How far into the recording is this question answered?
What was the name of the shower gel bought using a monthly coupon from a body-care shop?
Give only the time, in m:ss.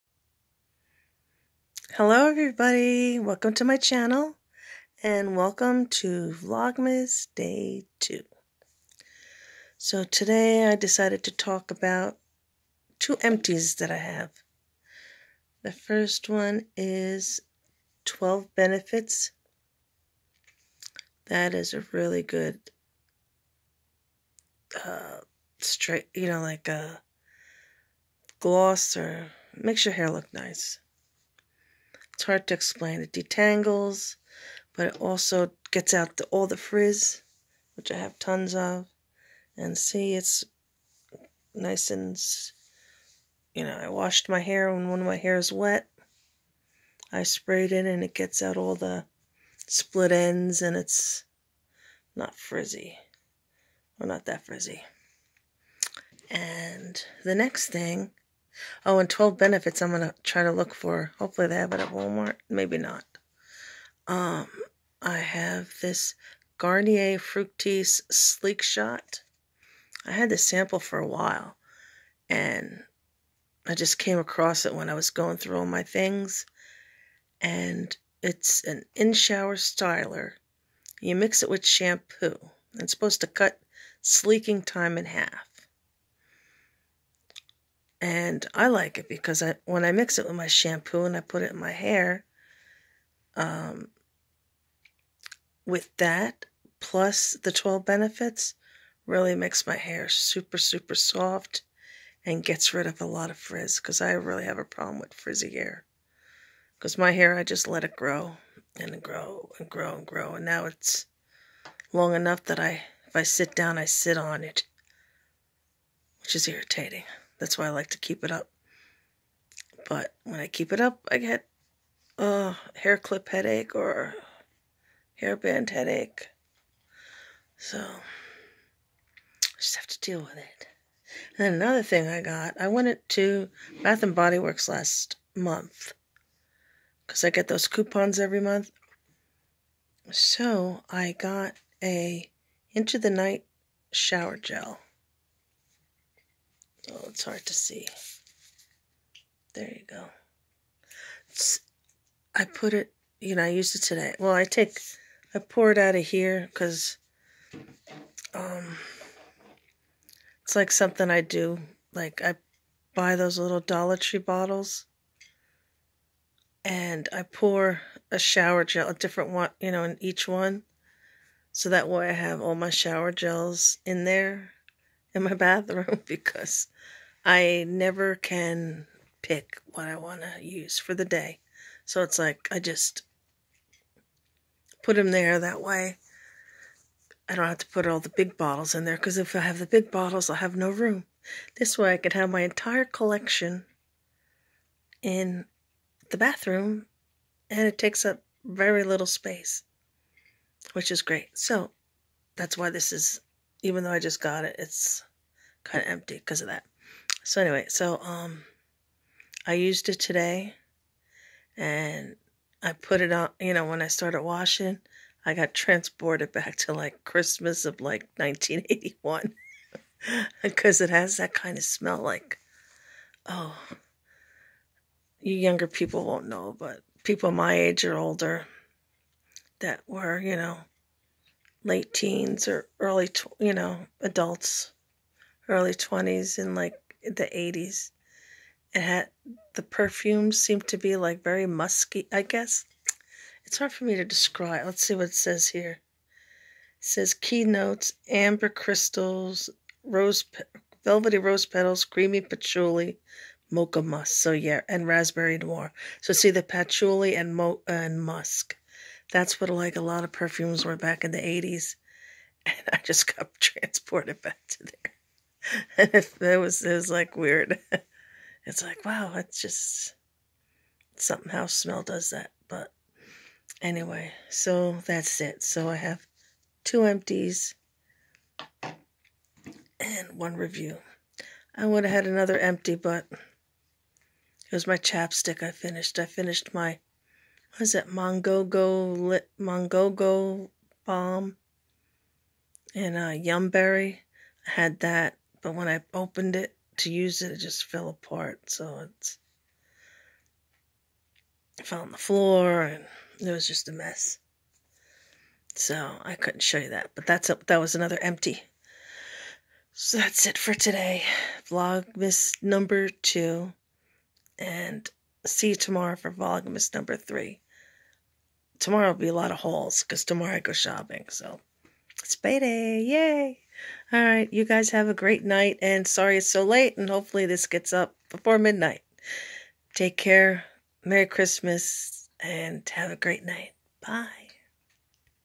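2:22.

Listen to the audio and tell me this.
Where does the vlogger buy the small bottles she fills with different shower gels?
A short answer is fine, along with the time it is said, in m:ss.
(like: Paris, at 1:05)
Dollar Tree, at 2:43.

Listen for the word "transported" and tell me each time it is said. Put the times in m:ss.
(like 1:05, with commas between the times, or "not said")
3:35, 4:23.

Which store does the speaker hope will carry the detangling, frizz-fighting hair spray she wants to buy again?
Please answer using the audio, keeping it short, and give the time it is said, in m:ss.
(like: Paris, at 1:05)
Walmart, at 1:01.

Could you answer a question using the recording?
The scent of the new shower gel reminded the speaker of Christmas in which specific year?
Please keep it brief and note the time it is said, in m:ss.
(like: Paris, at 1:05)
1981, at 3:38.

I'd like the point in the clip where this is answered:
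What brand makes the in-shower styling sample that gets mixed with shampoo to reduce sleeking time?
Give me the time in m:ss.
1:06.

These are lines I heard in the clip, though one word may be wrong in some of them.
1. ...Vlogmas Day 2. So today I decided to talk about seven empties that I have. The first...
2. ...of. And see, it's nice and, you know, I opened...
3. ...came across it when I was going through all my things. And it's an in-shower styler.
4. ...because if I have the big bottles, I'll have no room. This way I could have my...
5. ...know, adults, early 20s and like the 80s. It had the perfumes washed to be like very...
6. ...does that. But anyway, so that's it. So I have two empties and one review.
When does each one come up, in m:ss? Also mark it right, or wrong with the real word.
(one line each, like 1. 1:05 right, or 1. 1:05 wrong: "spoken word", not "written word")
1. 0:06 wrong: "two", not "seven"
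2. 0:38 wrong: "washed", not "opened"
3. 1:13 right
4. 3:08 right
5. 3:53 wrong: "seemed", not "washed"
6. 4:31 right.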